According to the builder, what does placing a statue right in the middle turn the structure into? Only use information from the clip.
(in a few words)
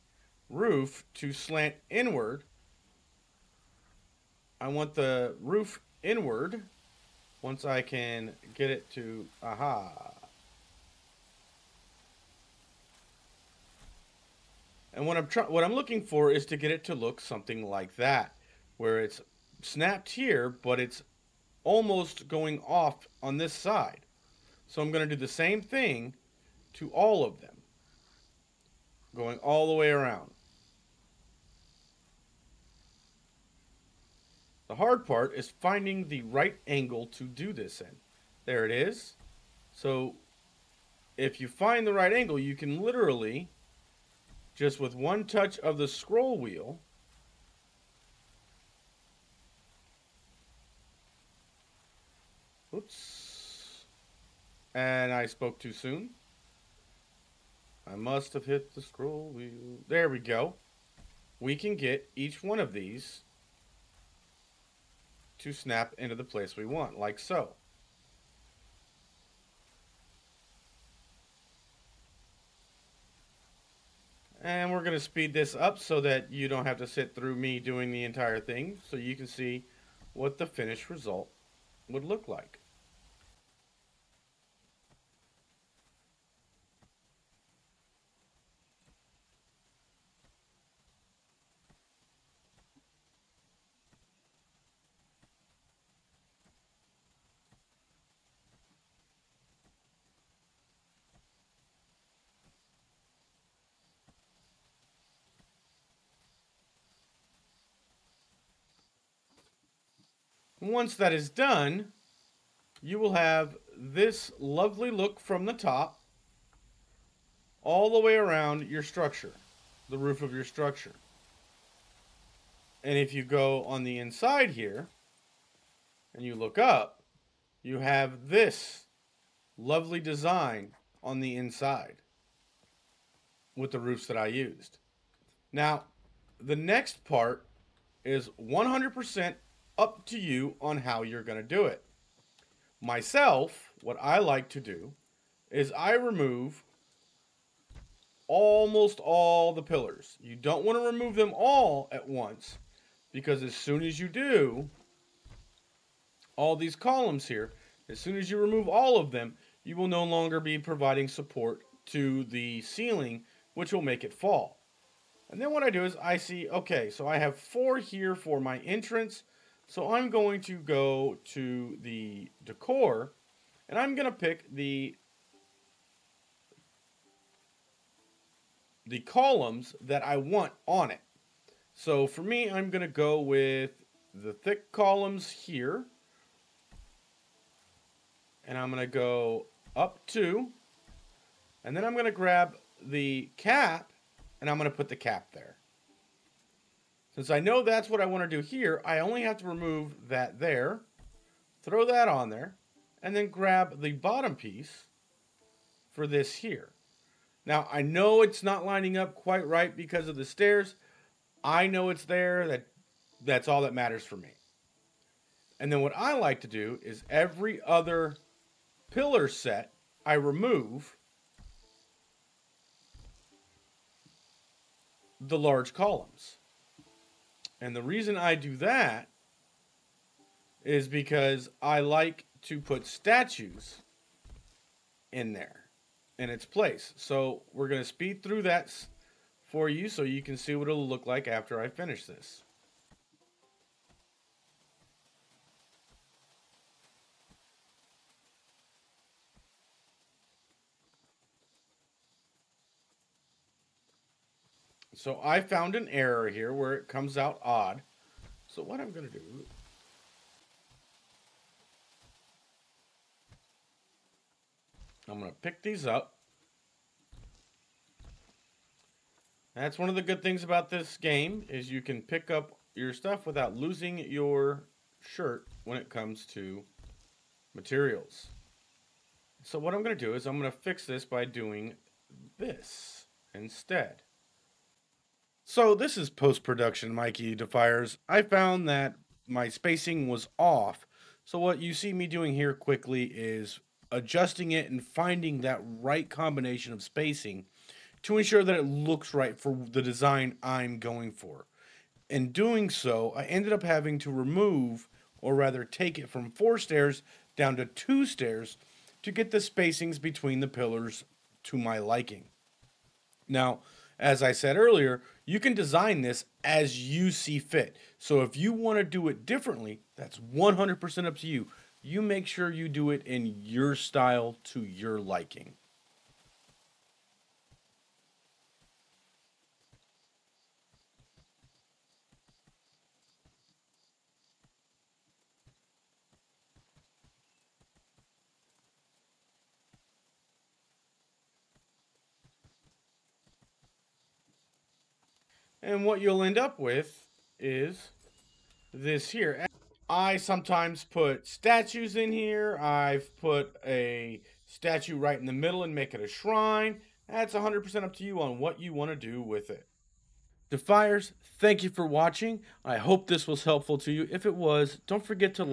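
A shrine.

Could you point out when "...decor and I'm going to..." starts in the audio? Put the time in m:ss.
2:52.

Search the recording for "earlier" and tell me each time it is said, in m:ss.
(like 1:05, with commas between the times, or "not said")
5:14.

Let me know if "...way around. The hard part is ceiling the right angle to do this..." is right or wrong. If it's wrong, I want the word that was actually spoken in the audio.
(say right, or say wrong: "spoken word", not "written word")
wrong: "finding", not "ceiling".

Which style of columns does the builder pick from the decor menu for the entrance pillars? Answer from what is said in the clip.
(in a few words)
Thick columns.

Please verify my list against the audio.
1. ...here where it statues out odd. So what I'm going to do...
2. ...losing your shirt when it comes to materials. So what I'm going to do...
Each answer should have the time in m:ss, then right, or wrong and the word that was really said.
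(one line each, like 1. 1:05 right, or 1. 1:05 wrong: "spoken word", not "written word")
1. 4:16 wrong: "comes", not "statues"
2. 4:33 right.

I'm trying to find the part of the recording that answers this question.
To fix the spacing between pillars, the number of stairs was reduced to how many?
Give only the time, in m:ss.
5:07.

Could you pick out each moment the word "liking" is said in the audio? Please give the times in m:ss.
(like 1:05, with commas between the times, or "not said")
5:11, 5:24.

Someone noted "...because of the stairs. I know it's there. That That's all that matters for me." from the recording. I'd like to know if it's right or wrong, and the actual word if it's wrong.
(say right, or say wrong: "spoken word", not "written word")
right.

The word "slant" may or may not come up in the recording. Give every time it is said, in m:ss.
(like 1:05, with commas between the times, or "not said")
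0:01.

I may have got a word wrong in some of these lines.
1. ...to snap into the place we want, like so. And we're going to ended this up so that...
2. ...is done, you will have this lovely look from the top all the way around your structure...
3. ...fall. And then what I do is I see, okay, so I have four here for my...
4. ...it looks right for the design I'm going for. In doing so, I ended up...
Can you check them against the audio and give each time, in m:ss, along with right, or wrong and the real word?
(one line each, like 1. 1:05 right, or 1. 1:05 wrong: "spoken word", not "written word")
1. 1:05 wrong: "speed", not "ended"
2. 1:51 right
3. 2:44 right
4. 4:58 right.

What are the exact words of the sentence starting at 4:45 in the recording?
So this is post-production Mikey Defiers.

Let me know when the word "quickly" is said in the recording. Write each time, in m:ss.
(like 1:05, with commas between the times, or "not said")
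4:52.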